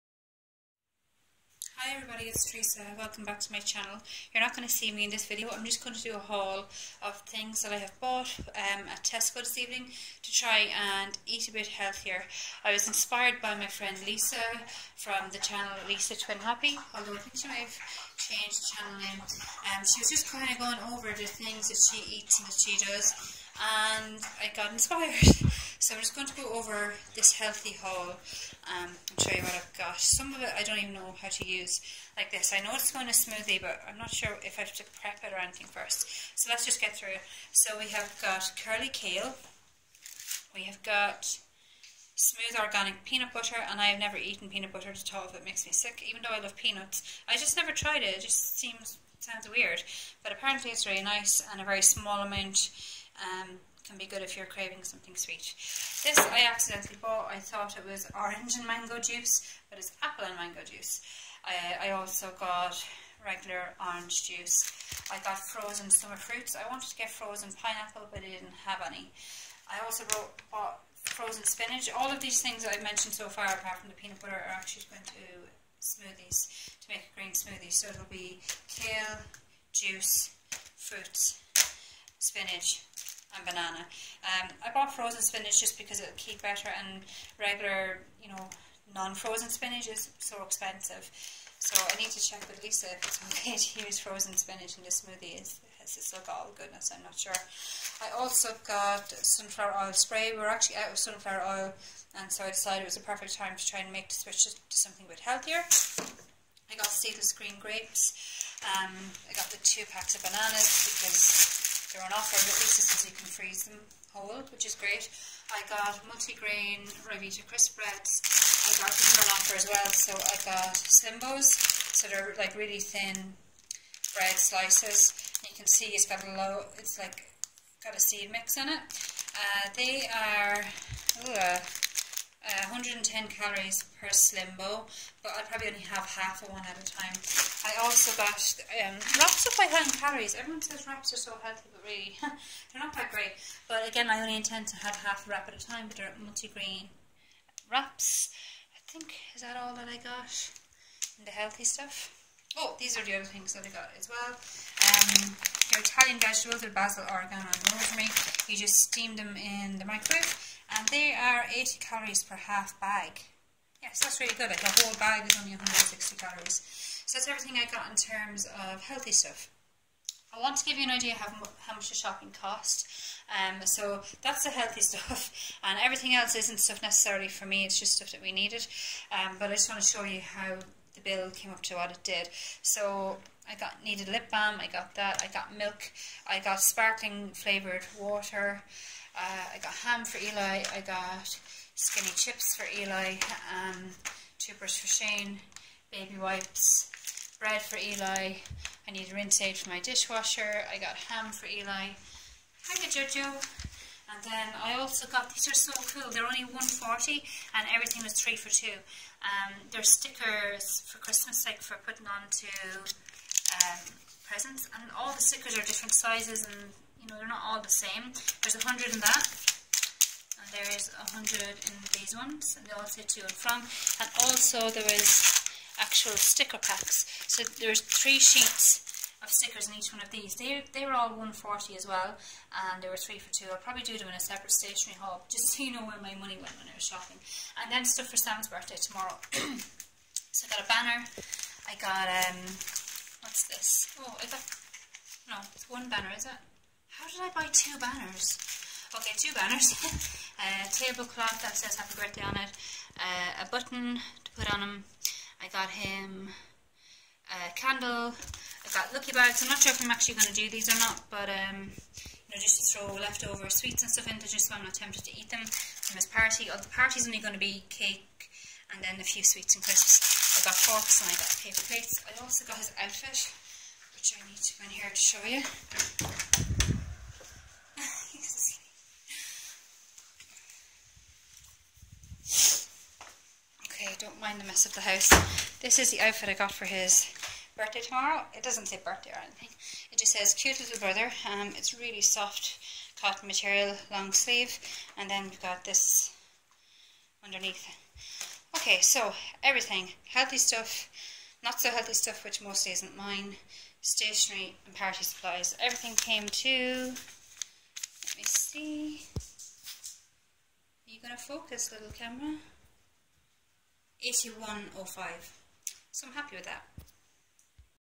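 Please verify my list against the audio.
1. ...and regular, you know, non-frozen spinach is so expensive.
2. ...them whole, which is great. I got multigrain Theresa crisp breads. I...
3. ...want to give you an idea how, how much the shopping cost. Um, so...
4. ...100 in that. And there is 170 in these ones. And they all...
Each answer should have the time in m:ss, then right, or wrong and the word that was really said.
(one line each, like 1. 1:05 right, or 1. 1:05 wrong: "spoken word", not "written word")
1. 1:26 right
2. 1:53 wrong: "Ryvita", not "Theresa"
3. 2:50 right
4. 3:38 wrong: "100", not "170".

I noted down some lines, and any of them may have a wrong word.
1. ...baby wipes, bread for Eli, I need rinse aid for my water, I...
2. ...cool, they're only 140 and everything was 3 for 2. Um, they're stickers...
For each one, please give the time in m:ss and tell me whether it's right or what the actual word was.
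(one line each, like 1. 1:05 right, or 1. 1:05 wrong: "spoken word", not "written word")
1. 3:15 wrong: "dishwasher", not "water"
2. 3:25 right.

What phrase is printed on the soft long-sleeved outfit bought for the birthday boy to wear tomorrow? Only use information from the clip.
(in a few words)
cute little brother.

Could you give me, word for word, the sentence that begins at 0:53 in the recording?
Um, can be good if you're craving something sweet.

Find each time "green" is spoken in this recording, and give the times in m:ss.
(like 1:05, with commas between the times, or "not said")
1:17, 1:47.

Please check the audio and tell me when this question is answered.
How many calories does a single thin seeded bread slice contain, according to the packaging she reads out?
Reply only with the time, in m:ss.
2:12.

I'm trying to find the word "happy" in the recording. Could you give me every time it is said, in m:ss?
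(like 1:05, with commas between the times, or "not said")
0:16, 4:11, 5:16.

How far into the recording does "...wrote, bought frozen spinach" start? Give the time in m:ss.
1:10.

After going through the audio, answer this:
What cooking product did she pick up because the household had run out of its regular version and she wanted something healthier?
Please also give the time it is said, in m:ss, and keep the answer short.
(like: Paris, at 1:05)
sunflower oil spray, at 1:39.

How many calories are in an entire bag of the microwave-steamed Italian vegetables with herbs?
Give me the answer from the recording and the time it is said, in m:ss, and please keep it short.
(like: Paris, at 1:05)
160, at 2:45.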